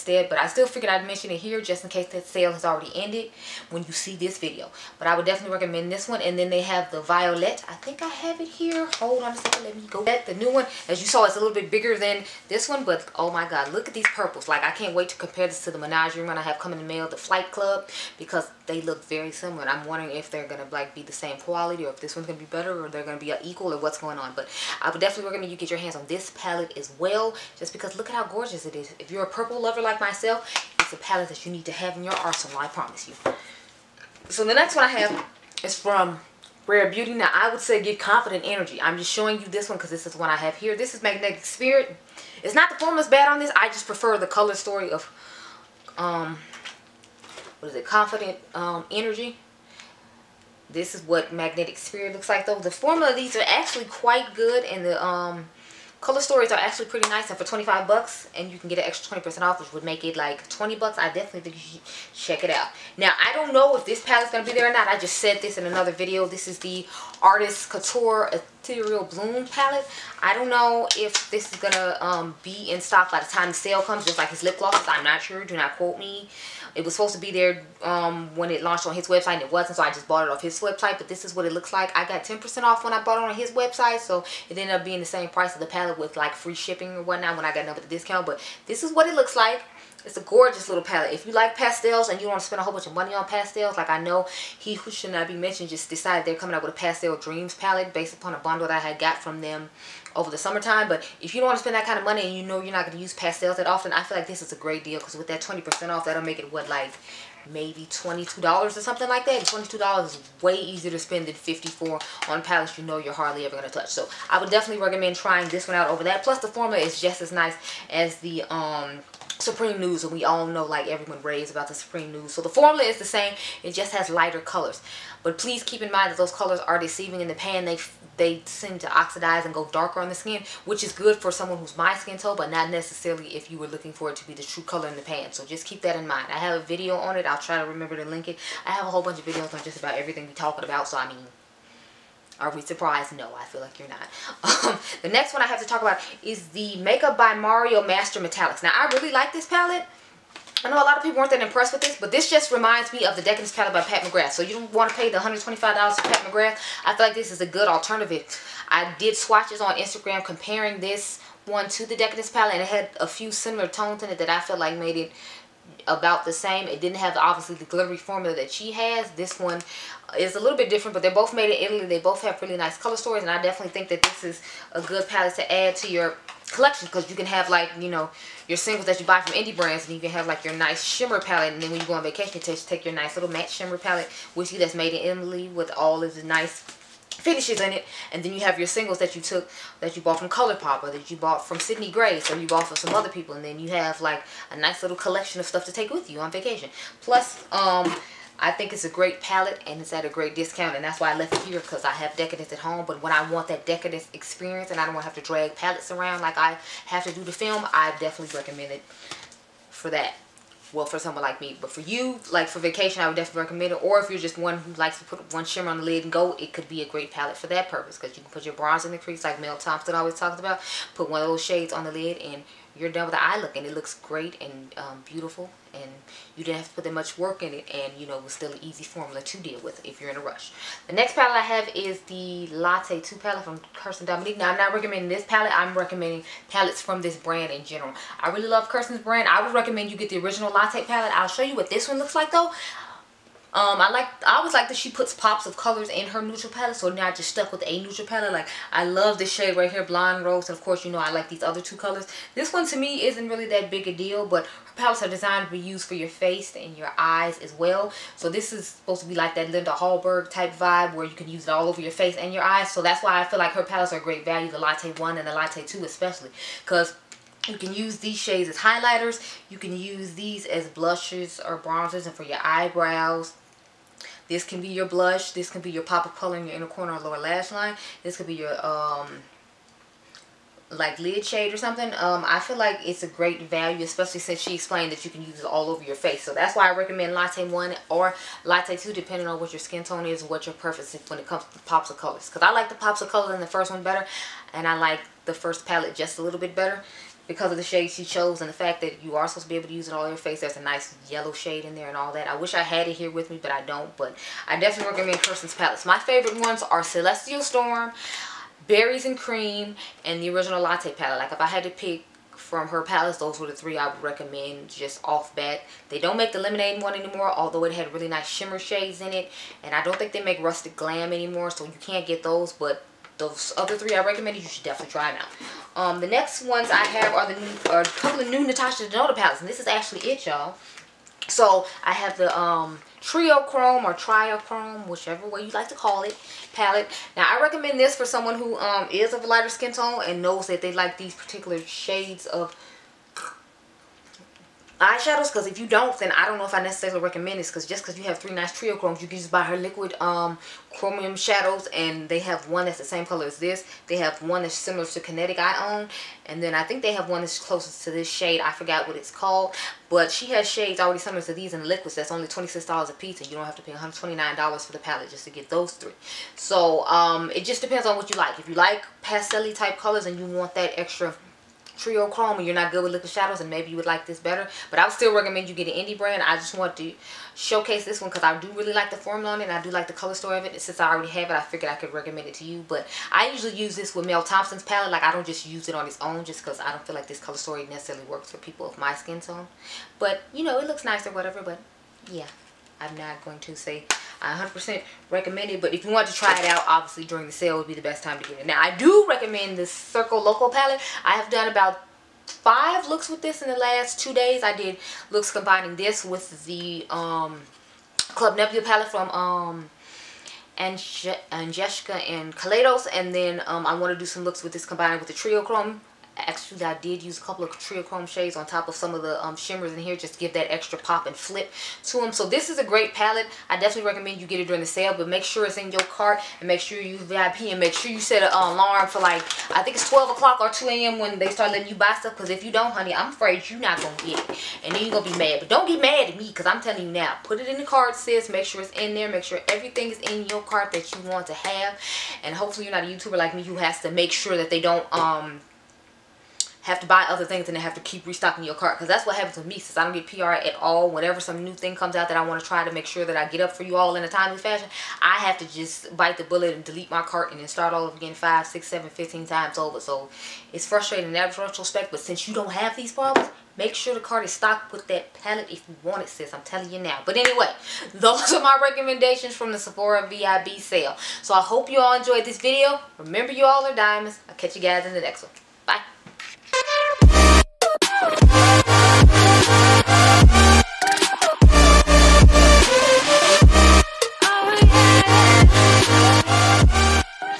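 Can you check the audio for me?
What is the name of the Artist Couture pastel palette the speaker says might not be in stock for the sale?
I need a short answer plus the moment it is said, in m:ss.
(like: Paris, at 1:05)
Ethereal Bloom, at 1:08.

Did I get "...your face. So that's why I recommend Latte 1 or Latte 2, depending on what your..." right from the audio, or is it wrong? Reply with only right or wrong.
right.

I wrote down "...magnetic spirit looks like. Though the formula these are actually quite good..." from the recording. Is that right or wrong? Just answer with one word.
right.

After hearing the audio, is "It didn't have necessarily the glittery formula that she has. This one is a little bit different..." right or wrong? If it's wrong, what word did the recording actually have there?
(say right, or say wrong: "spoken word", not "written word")
wrong: "obviously", not "necessarily".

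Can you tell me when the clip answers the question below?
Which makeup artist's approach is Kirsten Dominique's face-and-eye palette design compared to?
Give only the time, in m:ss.
4:19.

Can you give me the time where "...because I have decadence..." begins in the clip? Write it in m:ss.
3:21.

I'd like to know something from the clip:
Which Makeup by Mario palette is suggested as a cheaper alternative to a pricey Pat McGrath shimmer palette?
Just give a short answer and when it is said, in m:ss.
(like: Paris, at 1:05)
Master Metallics, at 2:27.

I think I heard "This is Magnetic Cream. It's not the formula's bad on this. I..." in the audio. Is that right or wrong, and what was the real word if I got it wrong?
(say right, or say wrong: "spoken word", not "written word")
wrong: "Spirit", not "Cream".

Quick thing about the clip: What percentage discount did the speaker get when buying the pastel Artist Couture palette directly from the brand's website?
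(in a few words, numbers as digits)
10%.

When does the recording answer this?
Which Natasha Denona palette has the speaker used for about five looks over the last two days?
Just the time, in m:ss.
6:39.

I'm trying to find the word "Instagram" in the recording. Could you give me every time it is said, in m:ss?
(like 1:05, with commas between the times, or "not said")
2:39.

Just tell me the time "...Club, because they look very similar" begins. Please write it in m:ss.
0:17.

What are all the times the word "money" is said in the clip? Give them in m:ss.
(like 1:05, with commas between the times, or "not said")
1:32, 1:42.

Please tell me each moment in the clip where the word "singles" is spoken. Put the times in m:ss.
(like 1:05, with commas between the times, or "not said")
2:58, 3:08.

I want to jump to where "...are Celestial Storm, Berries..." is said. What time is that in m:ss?
5:06.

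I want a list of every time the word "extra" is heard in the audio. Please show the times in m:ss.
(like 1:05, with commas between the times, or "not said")
0:58, 6:10, 7:00.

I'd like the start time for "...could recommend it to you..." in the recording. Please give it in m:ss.
6:21.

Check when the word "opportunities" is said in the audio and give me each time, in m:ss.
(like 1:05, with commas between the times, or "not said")
not said.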